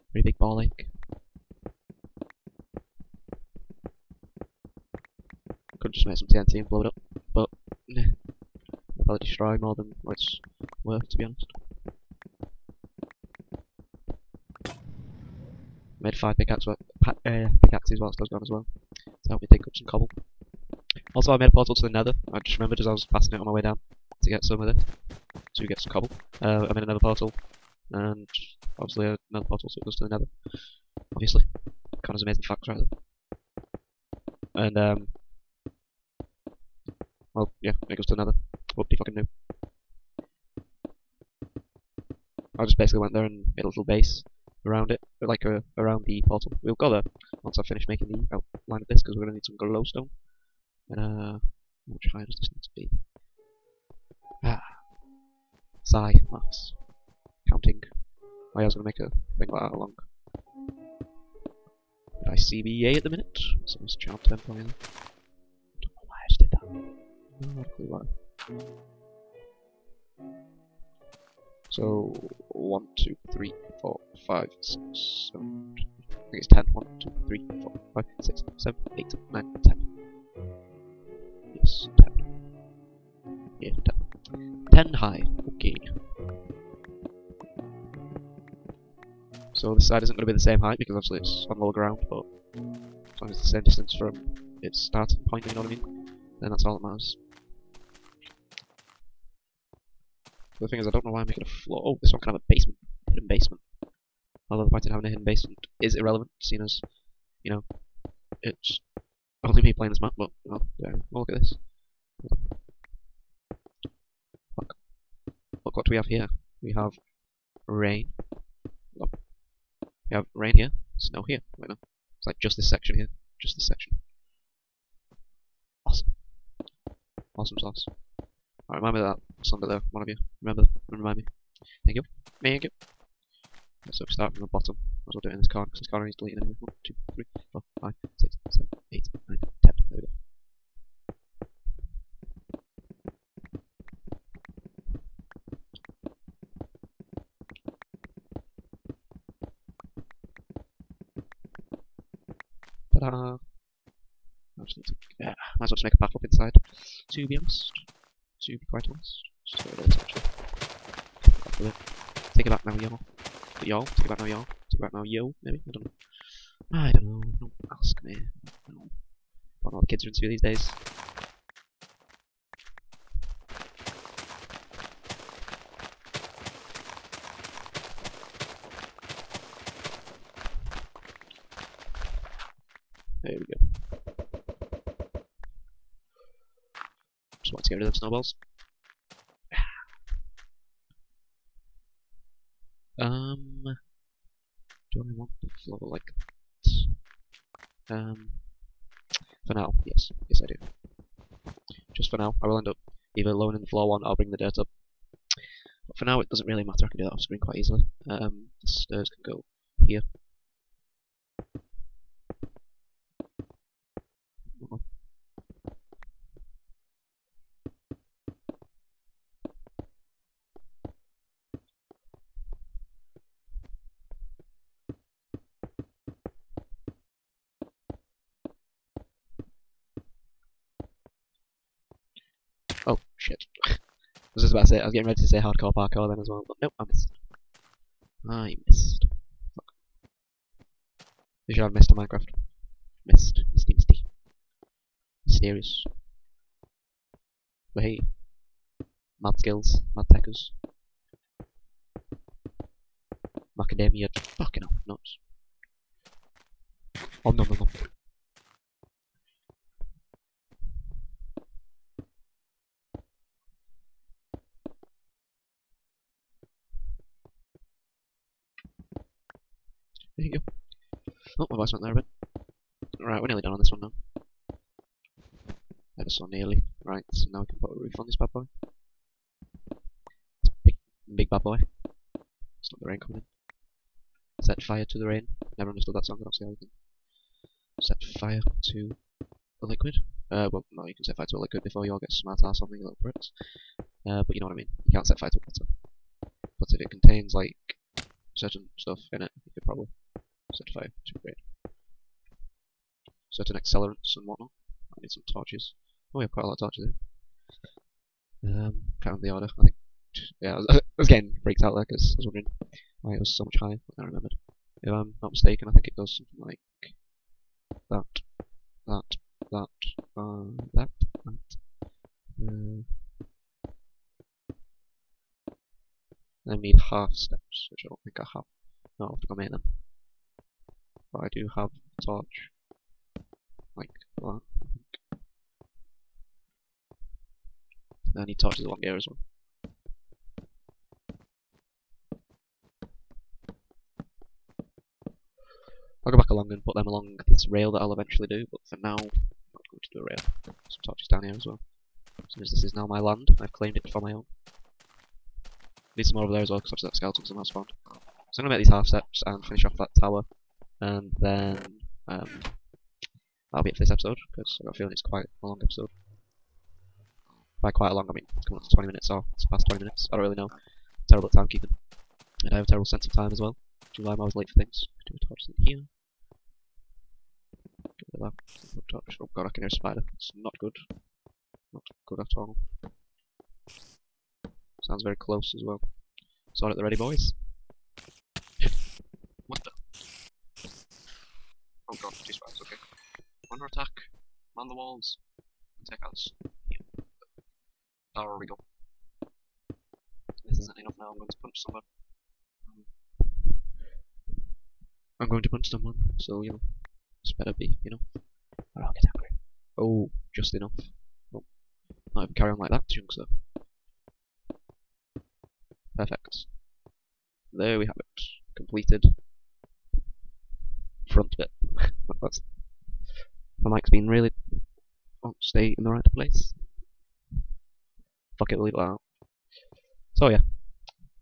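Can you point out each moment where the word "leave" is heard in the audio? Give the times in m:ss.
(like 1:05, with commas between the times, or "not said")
7:08.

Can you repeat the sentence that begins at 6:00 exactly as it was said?
And then um, that'll be it for this episode because I've got a feeling it's quite a long episode.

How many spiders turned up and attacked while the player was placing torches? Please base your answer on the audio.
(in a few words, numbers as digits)
2.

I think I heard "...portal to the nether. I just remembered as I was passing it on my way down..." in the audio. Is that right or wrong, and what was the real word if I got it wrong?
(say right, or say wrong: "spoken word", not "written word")
right.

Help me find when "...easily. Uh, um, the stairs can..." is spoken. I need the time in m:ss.
3:27.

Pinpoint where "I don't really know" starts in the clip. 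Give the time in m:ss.
6:10.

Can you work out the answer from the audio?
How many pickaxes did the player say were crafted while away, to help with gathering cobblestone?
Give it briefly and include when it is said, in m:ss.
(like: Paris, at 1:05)
5, at 0:16.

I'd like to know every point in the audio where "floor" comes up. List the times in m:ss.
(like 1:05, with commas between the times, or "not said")
1:41, 3:15, 3:23.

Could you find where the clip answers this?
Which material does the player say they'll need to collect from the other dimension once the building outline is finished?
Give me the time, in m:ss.
0:49.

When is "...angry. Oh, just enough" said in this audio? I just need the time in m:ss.
6:49.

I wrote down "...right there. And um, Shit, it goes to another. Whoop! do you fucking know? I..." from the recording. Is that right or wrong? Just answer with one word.
wrong.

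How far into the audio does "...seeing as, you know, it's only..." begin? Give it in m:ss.
1:46.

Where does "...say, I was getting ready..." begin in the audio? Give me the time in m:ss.
3:54.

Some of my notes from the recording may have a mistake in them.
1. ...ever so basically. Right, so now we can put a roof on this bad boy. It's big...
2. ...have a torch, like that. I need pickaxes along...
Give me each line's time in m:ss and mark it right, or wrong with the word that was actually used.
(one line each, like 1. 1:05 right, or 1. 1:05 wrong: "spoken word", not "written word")
1. 4:36 wrong: "nearly", not "basically"
2. 5:31 wrong: "torches", not "pickaxes".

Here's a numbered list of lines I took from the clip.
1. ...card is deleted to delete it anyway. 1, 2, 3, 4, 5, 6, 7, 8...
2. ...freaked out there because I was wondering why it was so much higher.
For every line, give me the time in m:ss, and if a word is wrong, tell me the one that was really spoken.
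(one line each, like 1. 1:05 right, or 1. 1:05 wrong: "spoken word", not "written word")
1. 2:15 right
2. 5:11 right.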